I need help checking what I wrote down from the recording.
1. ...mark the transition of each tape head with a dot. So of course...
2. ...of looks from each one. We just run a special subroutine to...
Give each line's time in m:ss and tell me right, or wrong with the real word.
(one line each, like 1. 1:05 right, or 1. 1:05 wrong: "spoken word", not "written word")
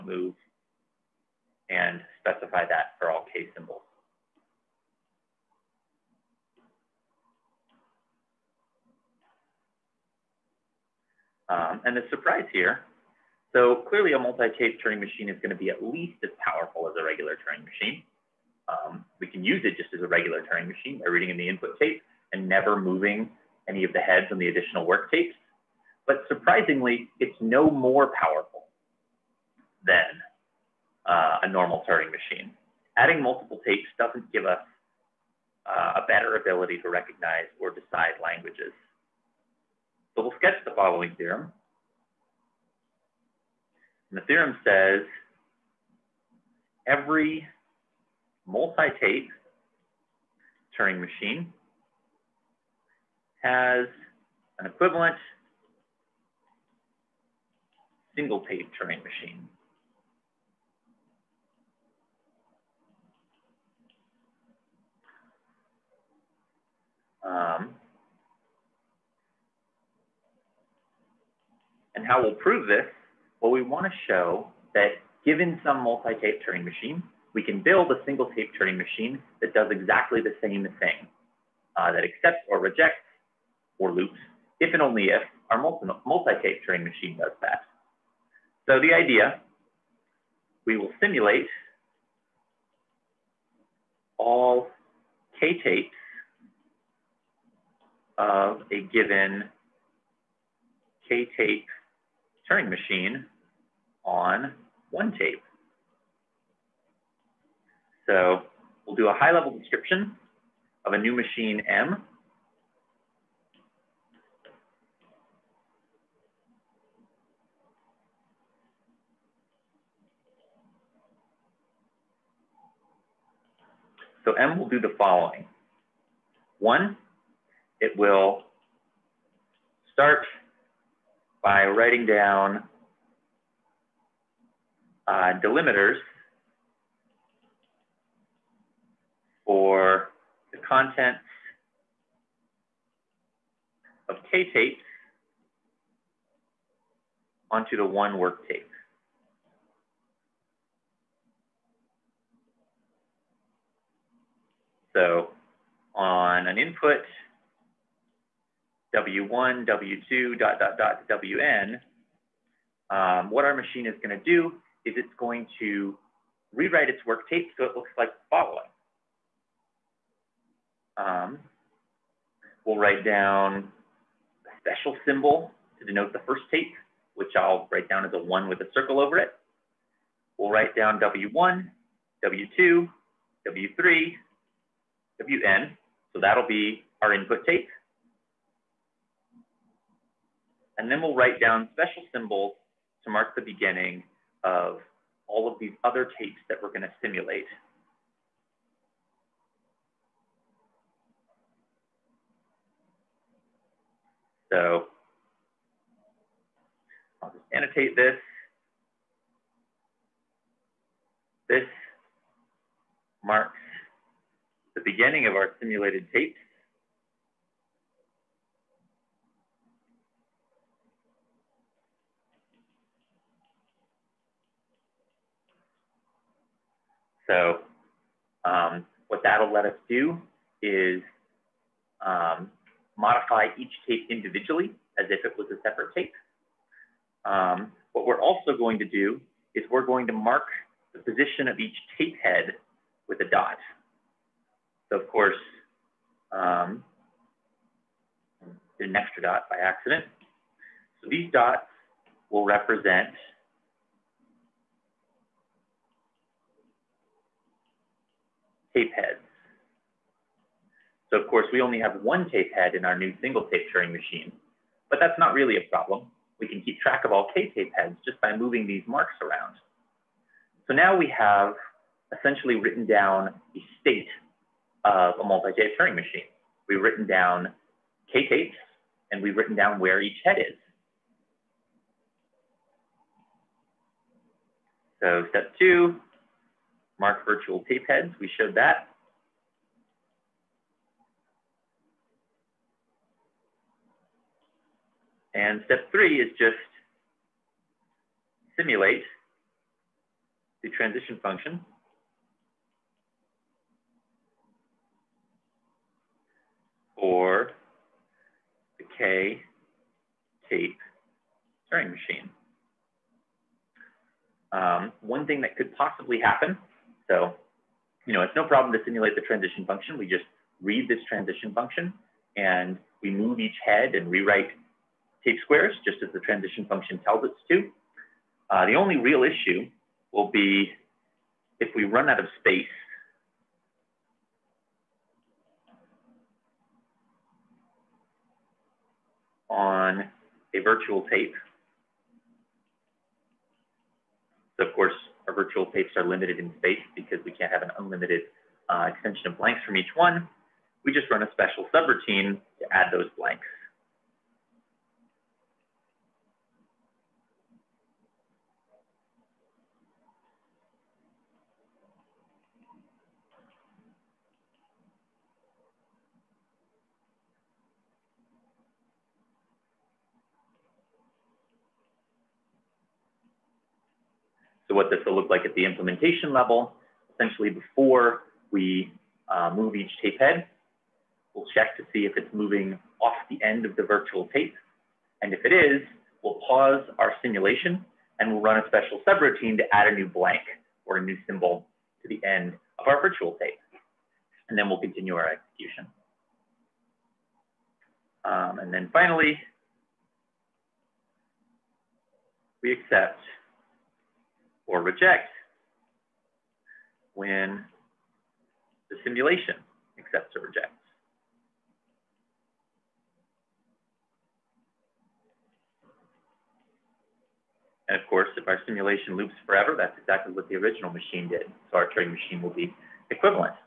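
1. 4:00 wrong: "position", not "transition"
2. 5:49 wrong: "blanks", not "looks".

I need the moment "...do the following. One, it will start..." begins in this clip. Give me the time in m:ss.
2:04.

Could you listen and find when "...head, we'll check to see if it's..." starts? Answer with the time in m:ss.
6:20.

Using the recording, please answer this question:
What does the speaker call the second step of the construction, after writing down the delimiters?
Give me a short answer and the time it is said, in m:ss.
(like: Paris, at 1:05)
Mark virtual tape heads, at 4:46.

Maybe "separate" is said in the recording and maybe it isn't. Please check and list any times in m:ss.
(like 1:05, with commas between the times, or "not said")
3:55.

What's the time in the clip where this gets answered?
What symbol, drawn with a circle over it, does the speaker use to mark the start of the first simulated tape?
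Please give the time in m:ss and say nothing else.
2:58.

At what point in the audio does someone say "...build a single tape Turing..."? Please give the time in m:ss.
1:17.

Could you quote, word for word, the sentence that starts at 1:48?
So we'll do a high level description of a new machine M.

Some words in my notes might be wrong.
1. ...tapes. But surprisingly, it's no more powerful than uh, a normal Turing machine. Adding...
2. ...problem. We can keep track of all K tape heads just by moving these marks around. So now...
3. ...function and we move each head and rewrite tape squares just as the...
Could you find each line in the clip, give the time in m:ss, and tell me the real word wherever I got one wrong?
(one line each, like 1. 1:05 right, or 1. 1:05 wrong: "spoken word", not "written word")
1. 0:25 right
2. 4:25 right
3. 5:21 right.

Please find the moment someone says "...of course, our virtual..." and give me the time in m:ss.
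5:44.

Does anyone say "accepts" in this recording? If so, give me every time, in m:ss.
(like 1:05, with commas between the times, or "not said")
1:22, 6:42, 6:49.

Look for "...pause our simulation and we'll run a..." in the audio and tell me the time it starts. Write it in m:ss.
6:26.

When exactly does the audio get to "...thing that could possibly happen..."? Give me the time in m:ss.
5:15.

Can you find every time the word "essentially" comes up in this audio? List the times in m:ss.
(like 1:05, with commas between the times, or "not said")
4:32, 6:17.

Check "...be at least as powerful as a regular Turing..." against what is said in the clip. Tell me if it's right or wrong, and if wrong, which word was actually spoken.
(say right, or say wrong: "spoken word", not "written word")
right.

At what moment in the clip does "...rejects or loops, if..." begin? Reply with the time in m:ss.
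1:22.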